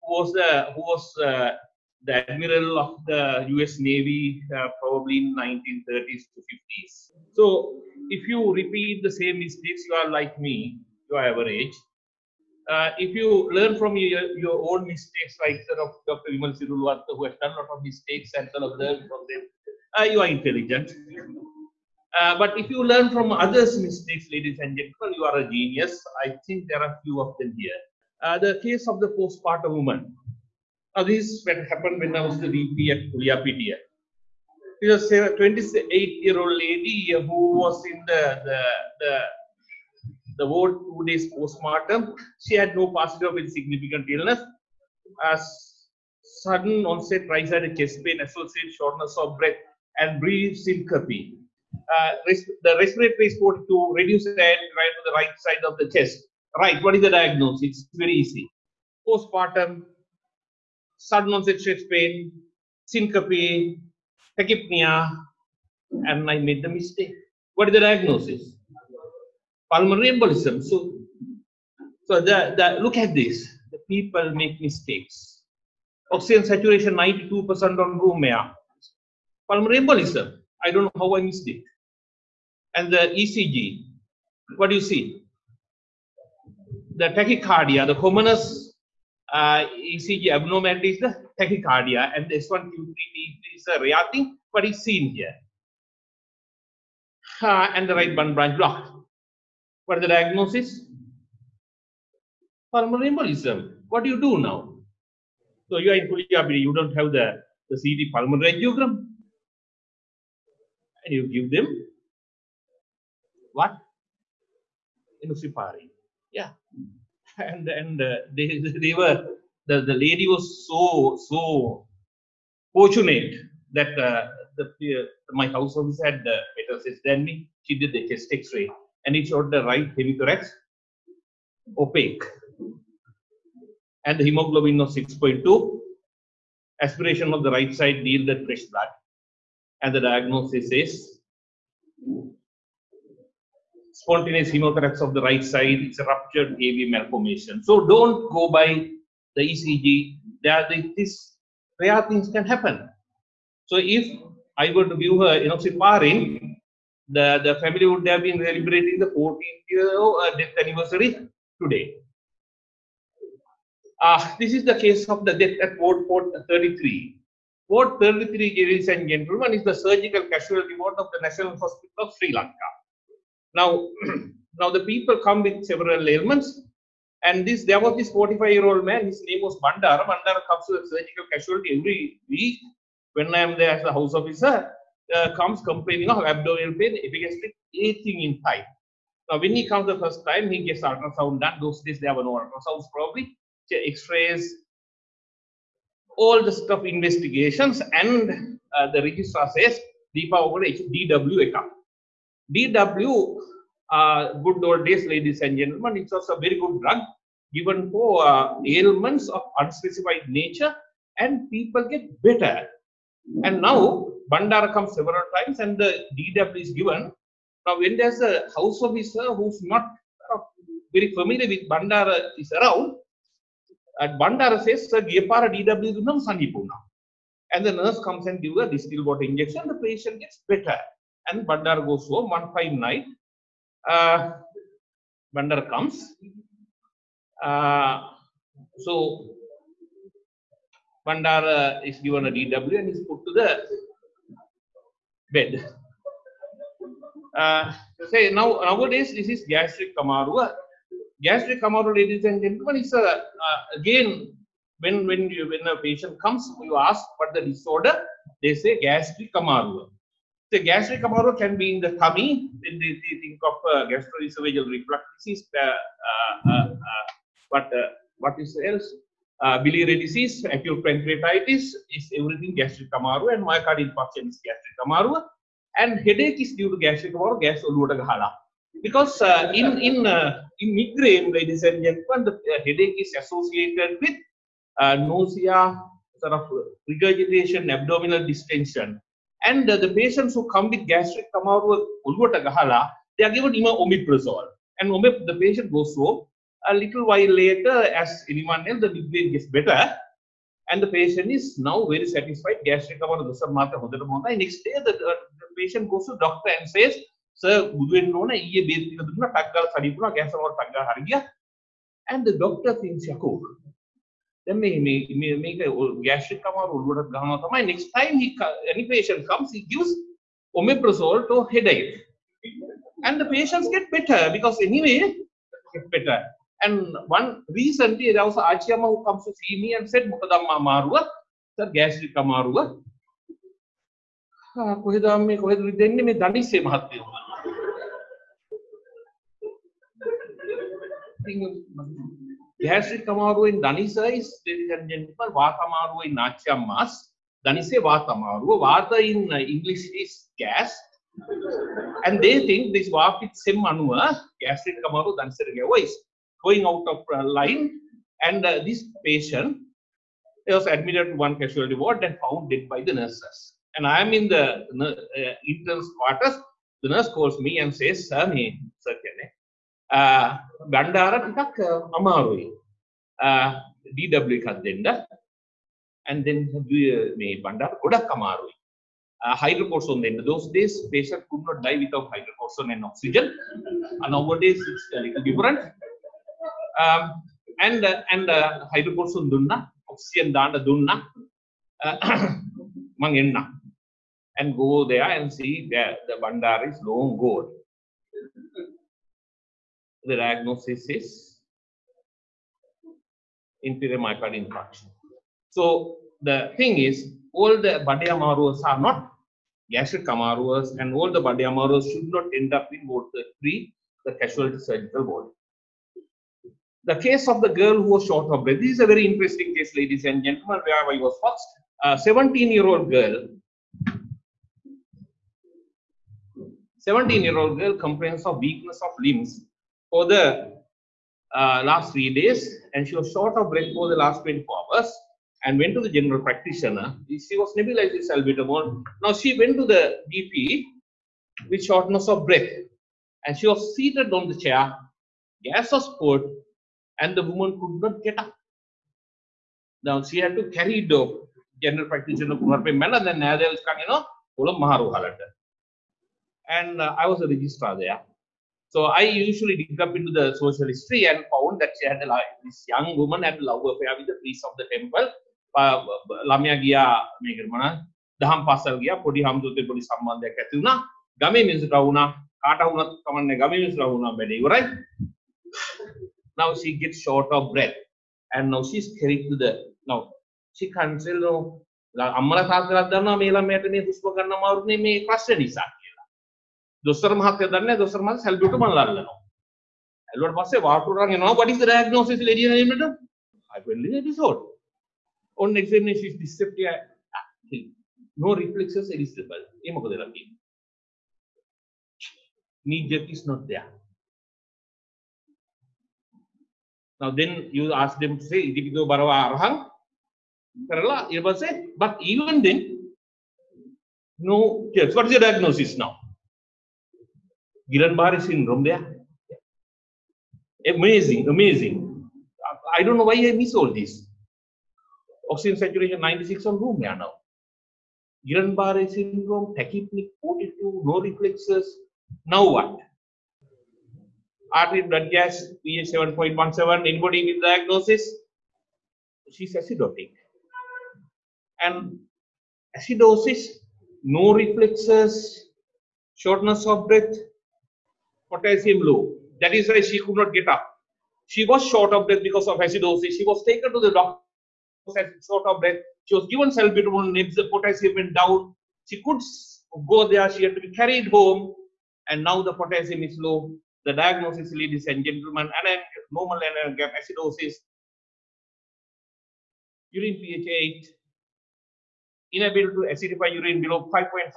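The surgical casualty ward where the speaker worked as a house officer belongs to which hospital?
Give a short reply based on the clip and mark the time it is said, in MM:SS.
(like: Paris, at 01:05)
National Hospital of Sri Lanka, at 02:51.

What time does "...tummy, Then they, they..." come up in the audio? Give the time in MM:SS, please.
04:21.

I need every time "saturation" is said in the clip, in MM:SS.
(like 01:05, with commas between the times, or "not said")
01:16, 08:45.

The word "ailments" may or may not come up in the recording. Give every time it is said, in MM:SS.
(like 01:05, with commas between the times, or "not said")
02:56, 03:28.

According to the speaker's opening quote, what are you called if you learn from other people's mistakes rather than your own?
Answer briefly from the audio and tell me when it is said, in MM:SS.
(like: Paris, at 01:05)
a genius, at 00:25.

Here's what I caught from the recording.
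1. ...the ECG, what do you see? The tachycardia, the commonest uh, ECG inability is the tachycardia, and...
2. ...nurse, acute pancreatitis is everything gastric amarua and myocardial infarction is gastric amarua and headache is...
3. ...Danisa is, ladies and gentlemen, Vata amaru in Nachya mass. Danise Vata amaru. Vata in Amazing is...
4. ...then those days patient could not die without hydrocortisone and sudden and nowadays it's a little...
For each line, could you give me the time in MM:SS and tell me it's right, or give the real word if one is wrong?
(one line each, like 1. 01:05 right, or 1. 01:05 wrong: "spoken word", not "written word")
1. 01:22 wrong: "abnormality", not "inability"
2. 04:30 wrong: "disease", not "nurse"
3. 05:43 wrong: "English", not "Amazing"
4. 06:20 wrong: "oxygen", not "sudden".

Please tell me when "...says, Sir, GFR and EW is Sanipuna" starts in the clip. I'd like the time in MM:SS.
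03:44.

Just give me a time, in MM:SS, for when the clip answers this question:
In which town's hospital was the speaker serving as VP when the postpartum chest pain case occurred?
00:33.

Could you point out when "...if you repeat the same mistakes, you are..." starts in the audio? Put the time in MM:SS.
00:08.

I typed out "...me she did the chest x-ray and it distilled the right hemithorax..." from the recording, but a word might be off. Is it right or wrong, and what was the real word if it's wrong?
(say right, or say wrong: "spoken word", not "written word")
wrong: "showed", not "distilled".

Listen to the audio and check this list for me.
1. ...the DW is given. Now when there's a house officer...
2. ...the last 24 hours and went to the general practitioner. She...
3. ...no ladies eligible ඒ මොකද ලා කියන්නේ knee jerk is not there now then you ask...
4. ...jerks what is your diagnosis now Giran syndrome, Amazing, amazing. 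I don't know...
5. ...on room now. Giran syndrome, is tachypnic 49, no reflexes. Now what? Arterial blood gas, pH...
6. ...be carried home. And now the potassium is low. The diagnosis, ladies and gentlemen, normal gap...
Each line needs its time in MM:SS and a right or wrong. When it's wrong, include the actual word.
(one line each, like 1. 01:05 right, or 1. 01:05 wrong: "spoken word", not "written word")
1. 03:35 right
2. 07:13 right
3. 08:18 wrong: "reflexes", not "ladies"
4. 08:34 right
5. 08:46 wrong: "42", not "49"
6. 09:20 right.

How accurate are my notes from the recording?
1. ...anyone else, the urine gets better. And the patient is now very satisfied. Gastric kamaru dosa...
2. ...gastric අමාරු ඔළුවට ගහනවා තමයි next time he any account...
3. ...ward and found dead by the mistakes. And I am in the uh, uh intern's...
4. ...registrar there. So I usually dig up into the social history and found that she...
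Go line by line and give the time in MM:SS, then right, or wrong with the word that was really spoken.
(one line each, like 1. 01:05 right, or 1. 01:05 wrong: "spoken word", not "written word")
1. 04:58 wrong: "migraine", not "urine"
2. 05:16 wrong: "patient", not "account"
3. 06:01 wrong: "nurses", not "mistakes"
4. 07:37 right.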